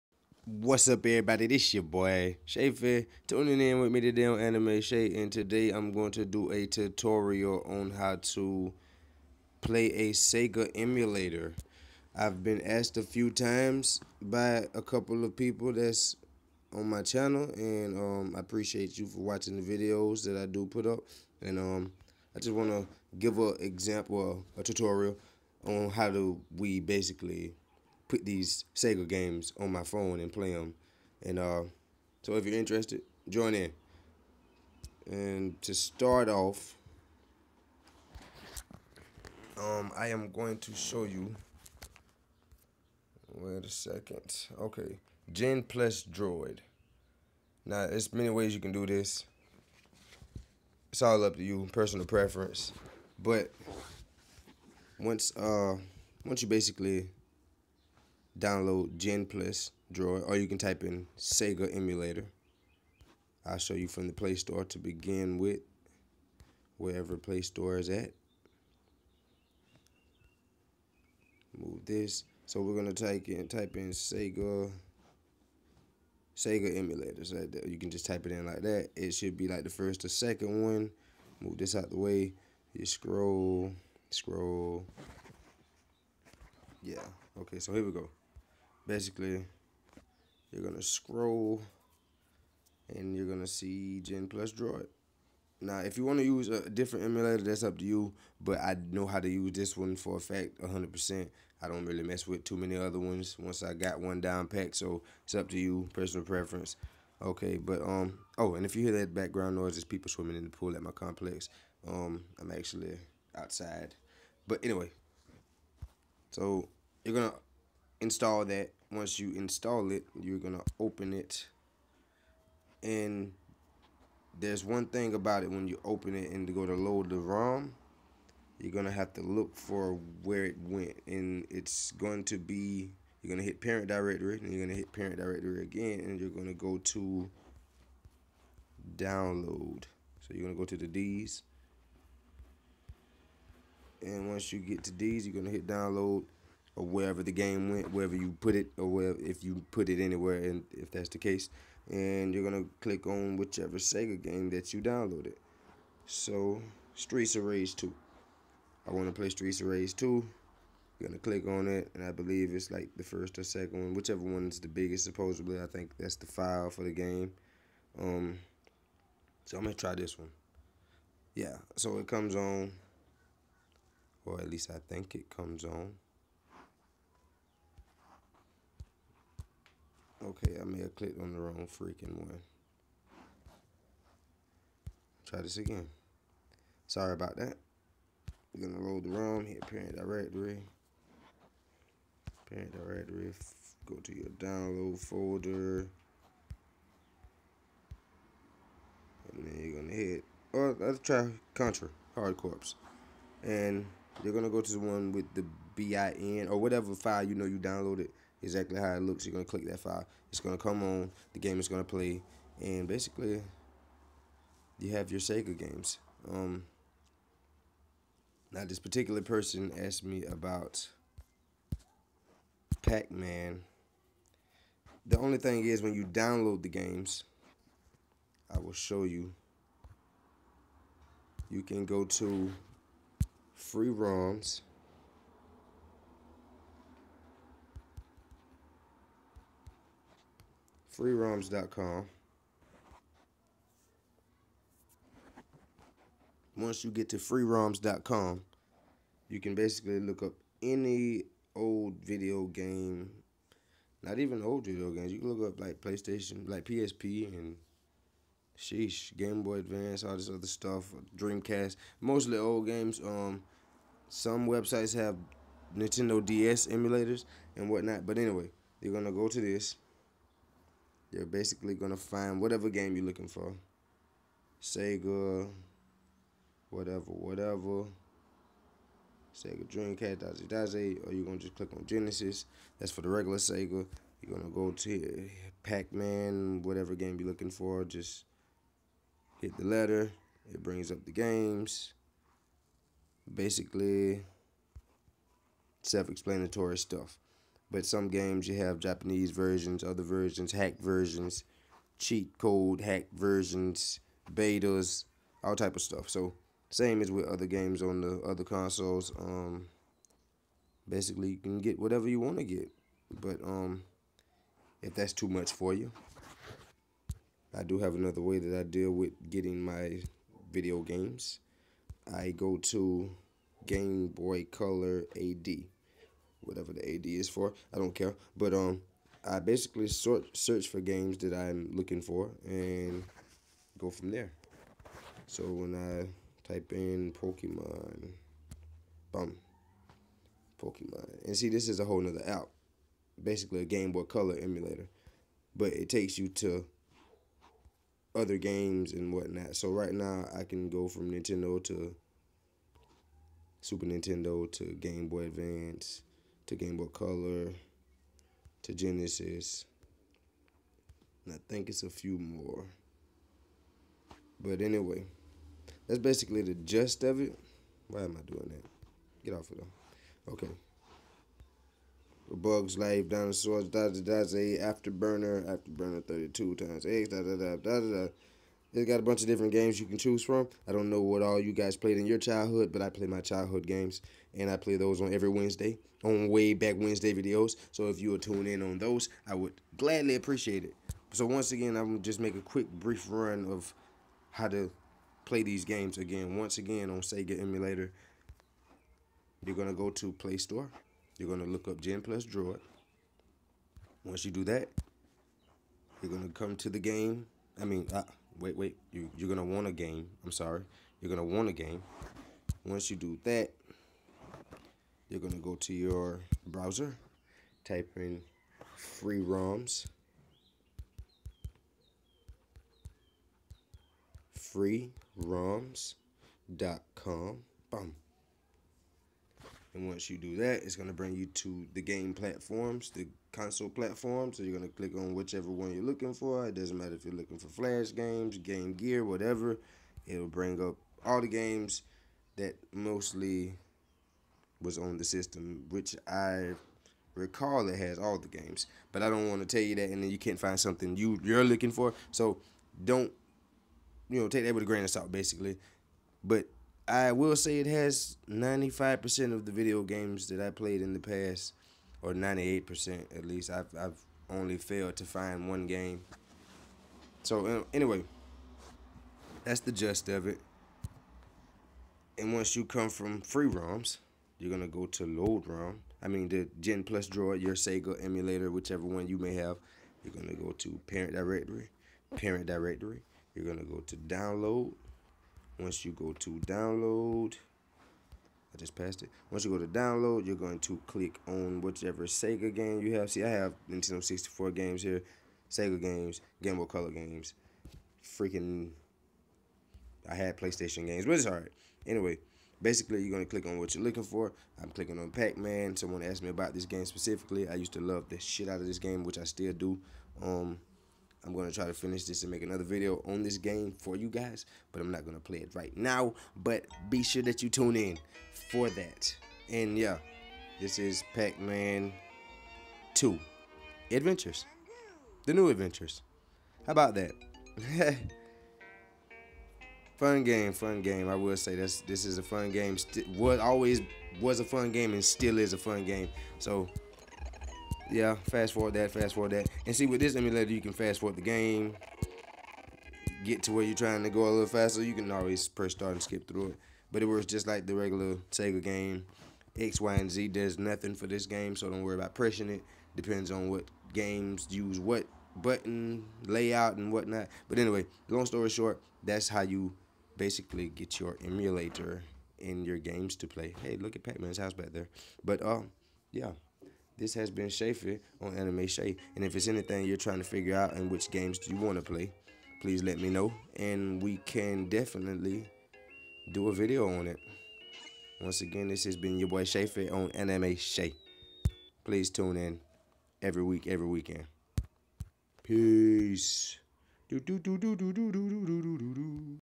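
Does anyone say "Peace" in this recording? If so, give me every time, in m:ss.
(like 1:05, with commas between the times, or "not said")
9:45.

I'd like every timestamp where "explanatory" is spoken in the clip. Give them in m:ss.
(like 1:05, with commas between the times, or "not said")
4:55.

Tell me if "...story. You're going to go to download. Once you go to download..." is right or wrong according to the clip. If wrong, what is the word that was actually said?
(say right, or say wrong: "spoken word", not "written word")
wrong: "directory", not "story".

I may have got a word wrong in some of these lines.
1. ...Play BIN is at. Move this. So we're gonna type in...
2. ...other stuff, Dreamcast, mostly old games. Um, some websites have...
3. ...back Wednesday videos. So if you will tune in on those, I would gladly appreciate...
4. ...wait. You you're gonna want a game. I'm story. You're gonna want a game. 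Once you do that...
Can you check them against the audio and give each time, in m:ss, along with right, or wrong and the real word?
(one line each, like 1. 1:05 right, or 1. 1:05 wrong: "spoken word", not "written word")
1. 1:07 wrong: "Store", not "BIN"
2. 4:20 right
3. 6:26 right
4. 6:48 wrong: "sorry", not "story".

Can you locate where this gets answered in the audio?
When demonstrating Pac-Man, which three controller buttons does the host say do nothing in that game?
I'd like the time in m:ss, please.
9:09.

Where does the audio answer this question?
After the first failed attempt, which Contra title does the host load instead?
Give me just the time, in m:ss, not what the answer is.
3:21.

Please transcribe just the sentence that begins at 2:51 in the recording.
Yeah, so it comes on, or at least I think it comes on.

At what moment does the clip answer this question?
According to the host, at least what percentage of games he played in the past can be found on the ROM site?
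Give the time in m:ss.
7:42.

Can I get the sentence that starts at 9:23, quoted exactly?
Hey, look at Pac-Man's house back there.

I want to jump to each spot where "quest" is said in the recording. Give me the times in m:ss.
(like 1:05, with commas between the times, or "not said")
not said.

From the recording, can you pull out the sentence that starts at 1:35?
Now, if you want to use a different emulator, that's up to you.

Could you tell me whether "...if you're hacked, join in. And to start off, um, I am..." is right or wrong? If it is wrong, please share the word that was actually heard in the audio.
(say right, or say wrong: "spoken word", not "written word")
wrong: "interested", not "hacked".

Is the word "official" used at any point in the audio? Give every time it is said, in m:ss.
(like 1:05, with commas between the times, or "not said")
not said.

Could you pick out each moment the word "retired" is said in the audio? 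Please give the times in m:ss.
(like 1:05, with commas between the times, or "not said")
not said.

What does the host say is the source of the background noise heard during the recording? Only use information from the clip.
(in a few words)
People swimming in the pool.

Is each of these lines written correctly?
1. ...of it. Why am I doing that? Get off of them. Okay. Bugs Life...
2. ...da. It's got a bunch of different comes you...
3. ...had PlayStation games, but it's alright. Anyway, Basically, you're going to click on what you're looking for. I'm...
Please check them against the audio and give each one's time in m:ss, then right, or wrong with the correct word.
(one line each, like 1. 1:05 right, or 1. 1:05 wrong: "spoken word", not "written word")
1. 6:07 right
2. 6:17 wrong: "games", not "comes"
3. 8:20 right.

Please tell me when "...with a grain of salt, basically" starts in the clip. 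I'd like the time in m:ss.
7:34.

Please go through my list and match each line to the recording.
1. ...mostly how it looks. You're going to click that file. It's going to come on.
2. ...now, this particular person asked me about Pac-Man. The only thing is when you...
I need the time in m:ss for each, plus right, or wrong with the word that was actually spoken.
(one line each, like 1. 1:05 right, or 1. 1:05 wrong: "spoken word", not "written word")
1. 3:28 wrong: "exactly", not "mostly"
2. 3:38 right.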